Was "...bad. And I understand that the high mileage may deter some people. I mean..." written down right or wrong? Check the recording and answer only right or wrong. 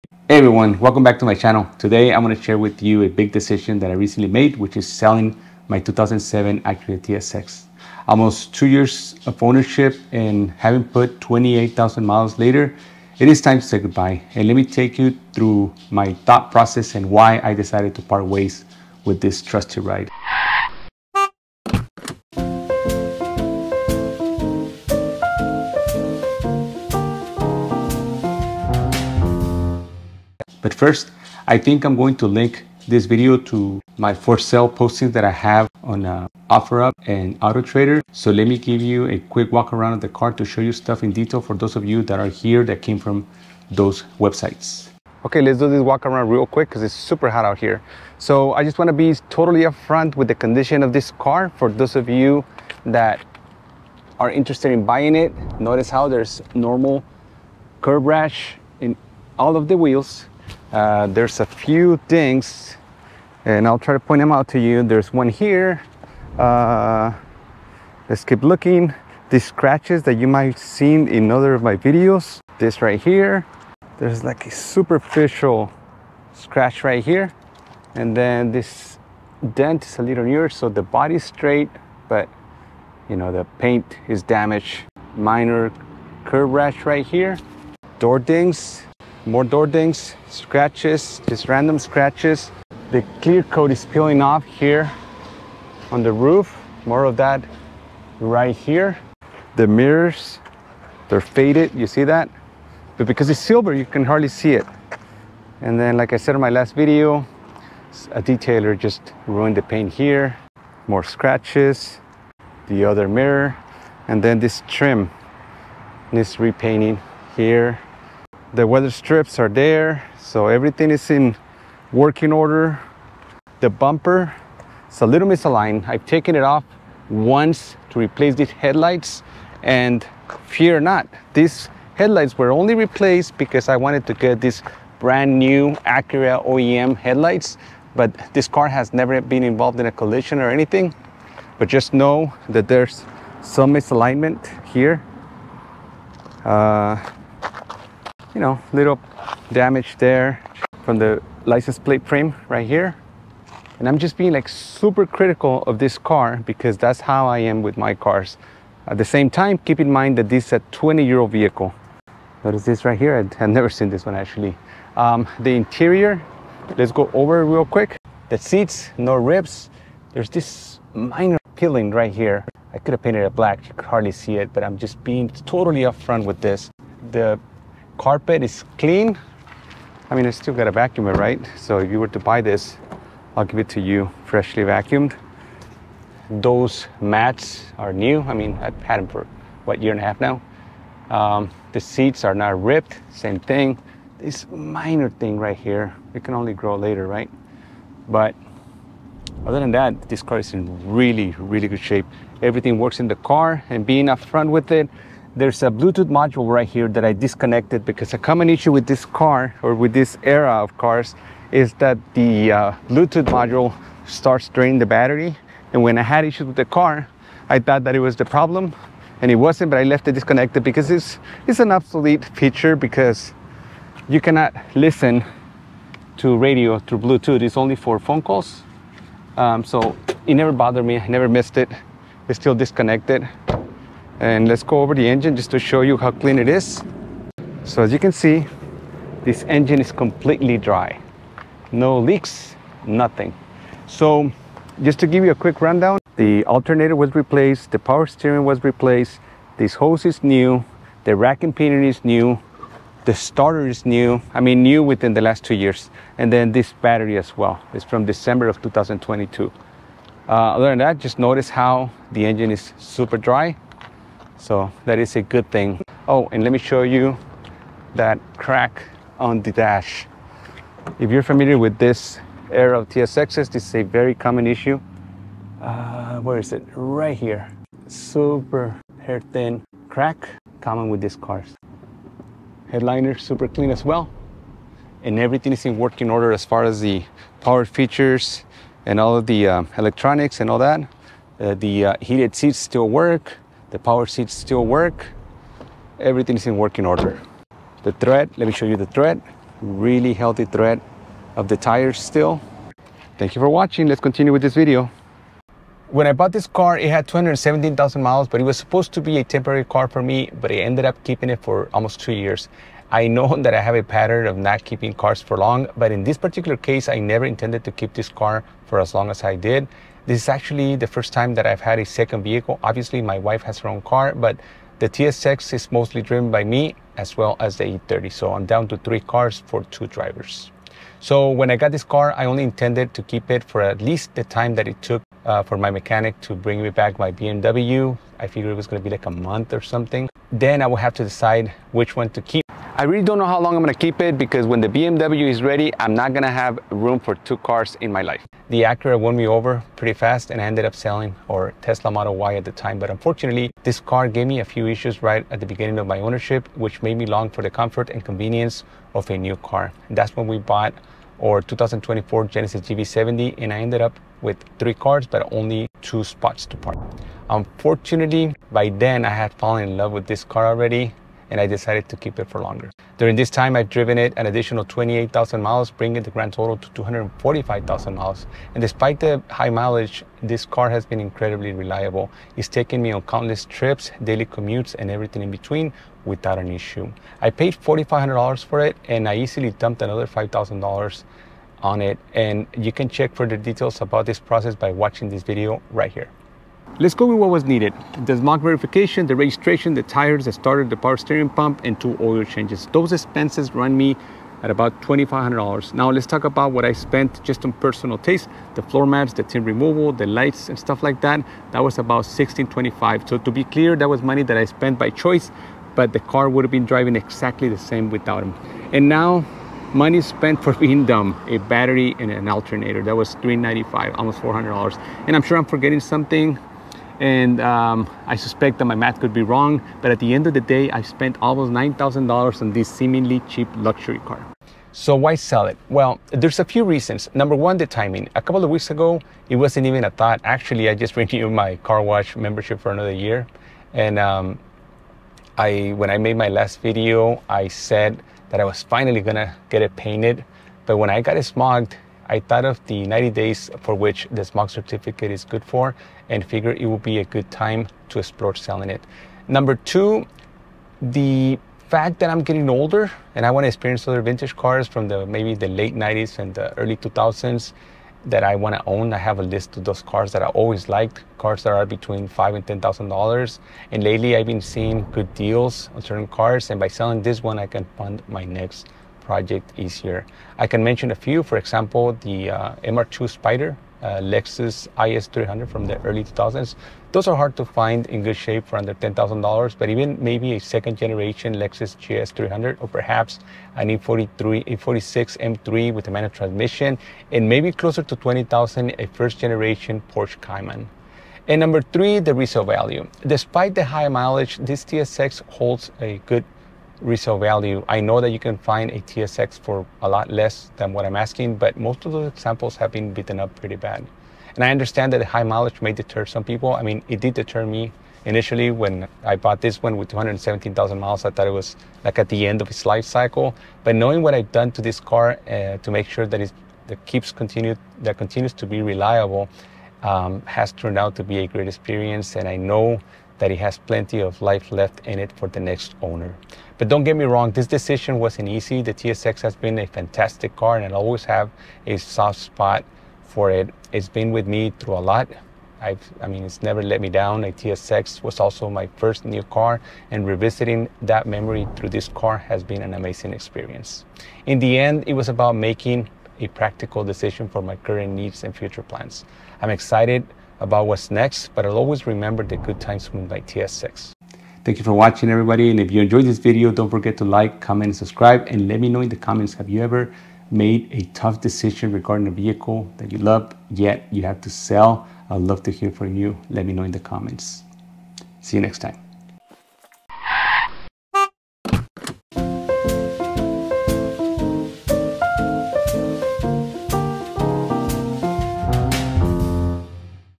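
right.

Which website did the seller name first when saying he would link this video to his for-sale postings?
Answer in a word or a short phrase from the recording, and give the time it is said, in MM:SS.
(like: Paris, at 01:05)
OfferUp, at 00:36.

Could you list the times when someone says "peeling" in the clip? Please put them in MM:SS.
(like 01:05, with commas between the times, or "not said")
01:33, 02:51.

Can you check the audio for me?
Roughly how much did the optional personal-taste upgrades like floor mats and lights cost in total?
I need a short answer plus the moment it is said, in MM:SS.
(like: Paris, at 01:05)
$1,625, at 06:52.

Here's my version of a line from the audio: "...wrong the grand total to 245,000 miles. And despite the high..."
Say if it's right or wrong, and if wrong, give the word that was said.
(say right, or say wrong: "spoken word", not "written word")
wrong: "bringing", not "wrong".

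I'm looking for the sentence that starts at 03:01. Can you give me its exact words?
So if you were to buy this, I'll give it to you freshly vacuumed.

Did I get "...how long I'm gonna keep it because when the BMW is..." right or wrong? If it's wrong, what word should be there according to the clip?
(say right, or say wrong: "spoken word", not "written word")
right.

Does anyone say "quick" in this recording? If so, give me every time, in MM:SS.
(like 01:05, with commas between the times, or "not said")
00:39, 00:46, 02:47, 04:05.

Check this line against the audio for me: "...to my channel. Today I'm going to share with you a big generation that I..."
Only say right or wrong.
wrong.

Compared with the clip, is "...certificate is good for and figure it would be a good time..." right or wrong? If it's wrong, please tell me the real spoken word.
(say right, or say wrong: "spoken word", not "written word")
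right.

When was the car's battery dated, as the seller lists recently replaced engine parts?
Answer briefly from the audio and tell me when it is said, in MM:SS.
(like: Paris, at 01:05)
December 2022, at 04:18.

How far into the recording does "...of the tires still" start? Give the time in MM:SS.
05:01.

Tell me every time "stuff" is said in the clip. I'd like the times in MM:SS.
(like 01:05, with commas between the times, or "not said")
00:40, 06:50.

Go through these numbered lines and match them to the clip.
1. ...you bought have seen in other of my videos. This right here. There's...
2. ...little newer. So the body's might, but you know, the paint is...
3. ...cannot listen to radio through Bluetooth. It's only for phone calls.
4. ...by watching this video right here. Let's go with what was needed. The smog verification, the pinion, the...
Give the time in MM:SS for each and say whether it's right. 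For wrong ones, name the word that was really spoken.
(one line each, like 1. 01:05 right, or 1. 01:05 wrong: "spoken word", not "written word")
1. 01:10 wrong: "might", not "bought"
2. 01:20 wrong: "straight", not "might"
3. 03:44 right
4. 06:34 wrong: "registration", not "pinion".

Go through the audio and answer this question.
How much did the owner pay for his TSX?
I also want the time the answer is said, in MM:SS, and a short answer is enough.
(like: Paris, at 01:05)
$4,500, at 06:27.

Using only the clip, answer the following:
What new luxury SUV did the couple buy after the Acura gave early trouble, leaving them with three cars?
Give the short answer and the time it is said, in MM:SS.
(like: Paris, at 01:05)
2024 Genesis GV70, at 06:01.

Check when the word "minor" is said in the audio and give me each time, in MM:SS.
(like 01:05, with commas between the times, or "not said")
01:25, 02:50, 03:14.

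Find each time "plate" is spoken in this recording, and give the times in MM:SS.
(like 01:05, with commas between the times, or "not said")
02:31.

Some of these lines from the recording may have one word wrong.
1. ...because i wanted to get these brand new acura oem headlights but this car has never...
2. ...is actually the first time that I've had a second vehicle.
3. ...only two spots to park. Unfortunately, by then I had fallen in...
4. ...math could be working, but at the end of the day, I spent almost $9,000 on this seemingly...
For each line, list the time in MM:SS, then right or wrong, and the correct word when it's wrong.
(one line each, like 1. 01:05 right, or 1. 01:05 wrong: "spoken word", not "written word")
1. 02:13 right
2. 05:20 right
3. 06:05 right
4. 07:08 wrong: "wrong", not "working".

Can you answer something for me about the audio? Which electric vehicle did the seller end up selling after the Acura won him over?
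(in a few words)
Tesla Model Y.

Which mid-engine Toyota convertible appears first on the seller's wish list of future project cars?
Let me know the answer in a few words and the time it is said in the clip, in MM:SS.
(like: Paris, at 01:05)
MR2 Spider, at 08:02.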